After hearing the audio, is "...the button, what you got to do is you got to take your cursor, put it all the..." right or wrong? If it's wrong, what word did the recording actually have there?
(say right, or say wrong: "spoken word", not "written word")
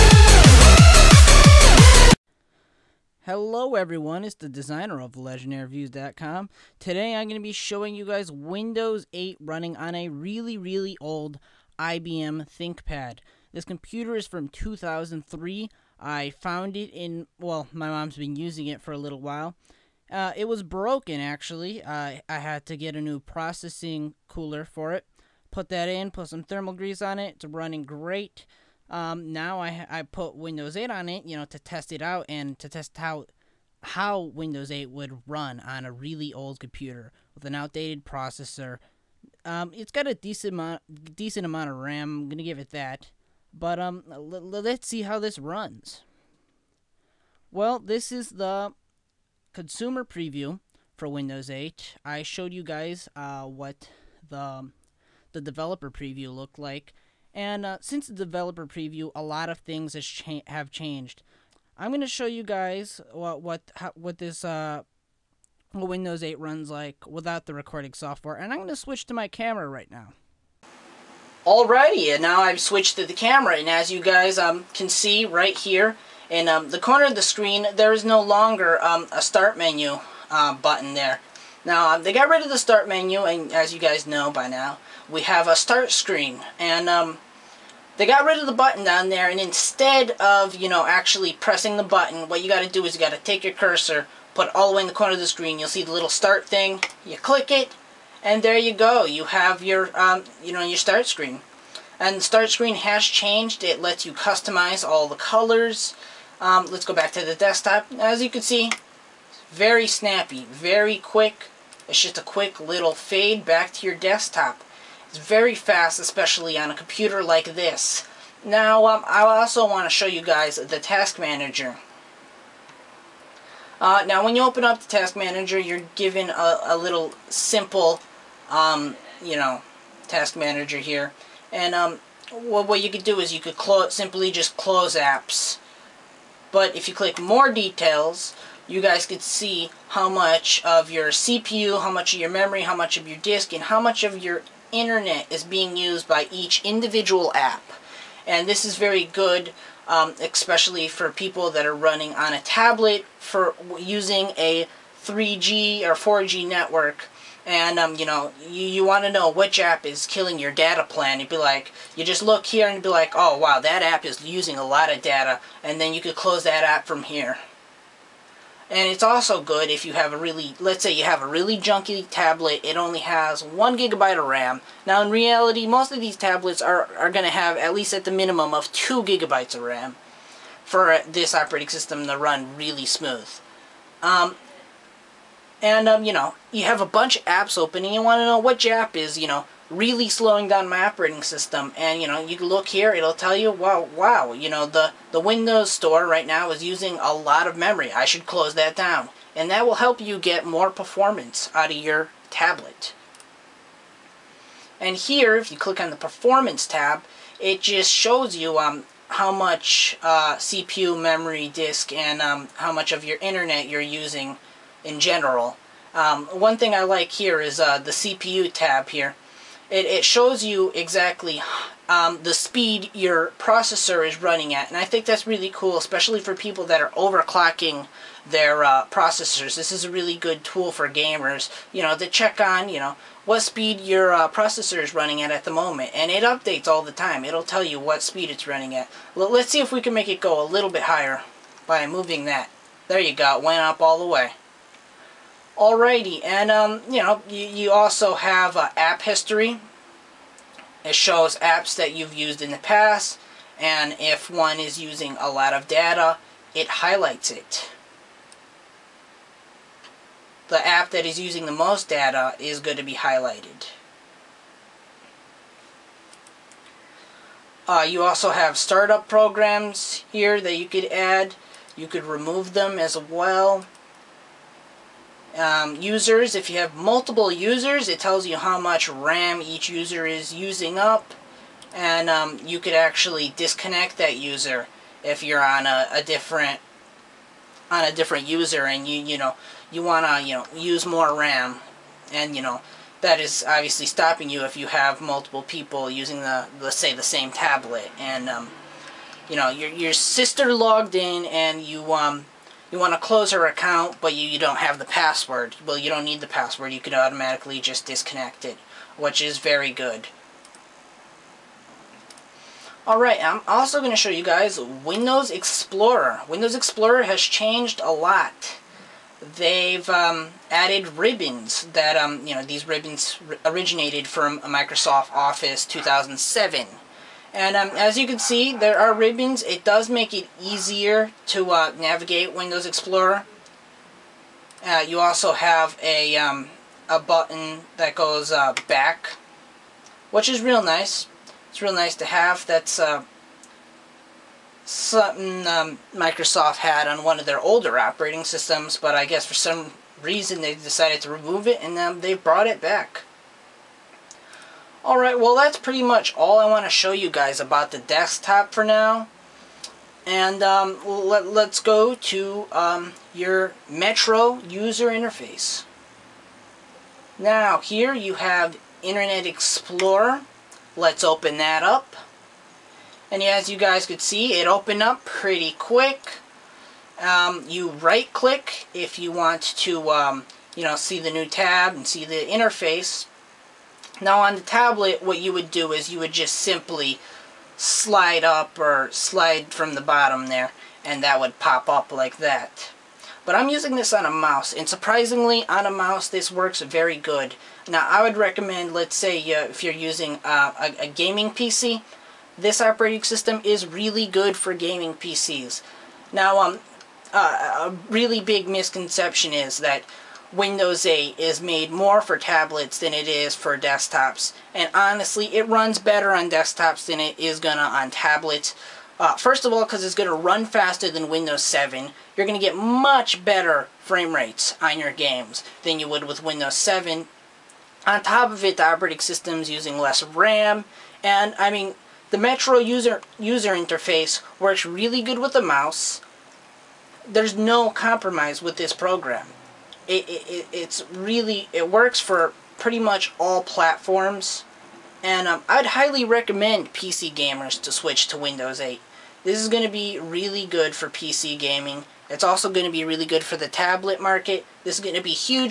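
right.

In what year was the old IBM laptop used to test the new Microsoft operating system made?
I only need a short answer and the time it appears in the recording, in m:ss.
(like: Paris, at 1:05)
2003, at 0:14.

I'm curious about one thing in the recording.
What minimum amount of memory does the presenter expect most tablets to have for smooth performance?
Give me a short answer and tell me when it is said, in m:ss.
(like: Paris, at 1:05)
2 gigabytes, at 2:58.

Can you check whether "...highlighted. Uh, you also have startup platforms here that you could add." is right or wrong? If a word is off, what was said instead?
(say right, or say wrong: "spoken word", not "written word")
wrong: "programs", not "platforms".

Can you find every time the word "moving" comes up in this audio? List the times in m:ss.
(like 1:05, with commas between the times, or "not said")
4:01.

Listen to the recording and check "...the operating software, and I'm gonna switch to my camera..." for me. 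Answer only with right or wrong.
wrong.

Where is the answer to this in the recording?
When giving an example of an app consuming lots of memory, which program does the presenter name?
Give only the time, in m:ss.
3:15.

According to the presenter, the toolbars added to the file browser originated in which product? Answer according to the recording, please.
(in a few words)
Microsoft Office 2007.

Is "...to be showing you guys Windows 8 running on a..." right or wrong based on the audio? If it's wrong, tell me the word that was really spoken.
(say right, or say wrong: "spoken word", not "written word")
right.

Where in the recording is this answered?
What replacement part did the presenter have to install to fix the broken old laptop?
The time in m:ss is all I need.
0:23.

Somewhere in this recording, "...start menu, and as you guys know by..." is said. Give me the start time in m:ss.
1:22.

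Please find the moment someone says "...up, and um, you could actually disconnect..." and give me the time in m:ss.
4:40.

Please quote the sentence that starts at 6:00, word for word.
And um, let, let's go to um, your Metro user interface.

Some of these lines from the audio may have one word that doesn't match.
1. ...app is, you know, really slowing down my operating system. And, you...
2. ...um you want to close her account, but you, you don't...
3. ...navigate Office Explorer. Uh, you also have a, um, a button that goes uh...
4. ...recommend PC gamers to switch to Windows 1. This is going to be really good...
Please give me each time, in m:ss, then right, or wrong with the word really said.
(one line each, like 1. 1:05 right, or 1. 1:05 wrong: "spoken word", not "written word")
1. 3:08 right
2. 5:01 right
3. 5:31 wrong: "Windows", not "Office"
4. 7:26 wrong: "8", not "1".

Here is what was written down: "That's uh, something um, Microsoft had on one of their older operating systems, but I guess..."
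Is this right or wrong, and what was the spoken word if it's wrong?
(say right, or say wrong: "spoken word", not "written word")
right.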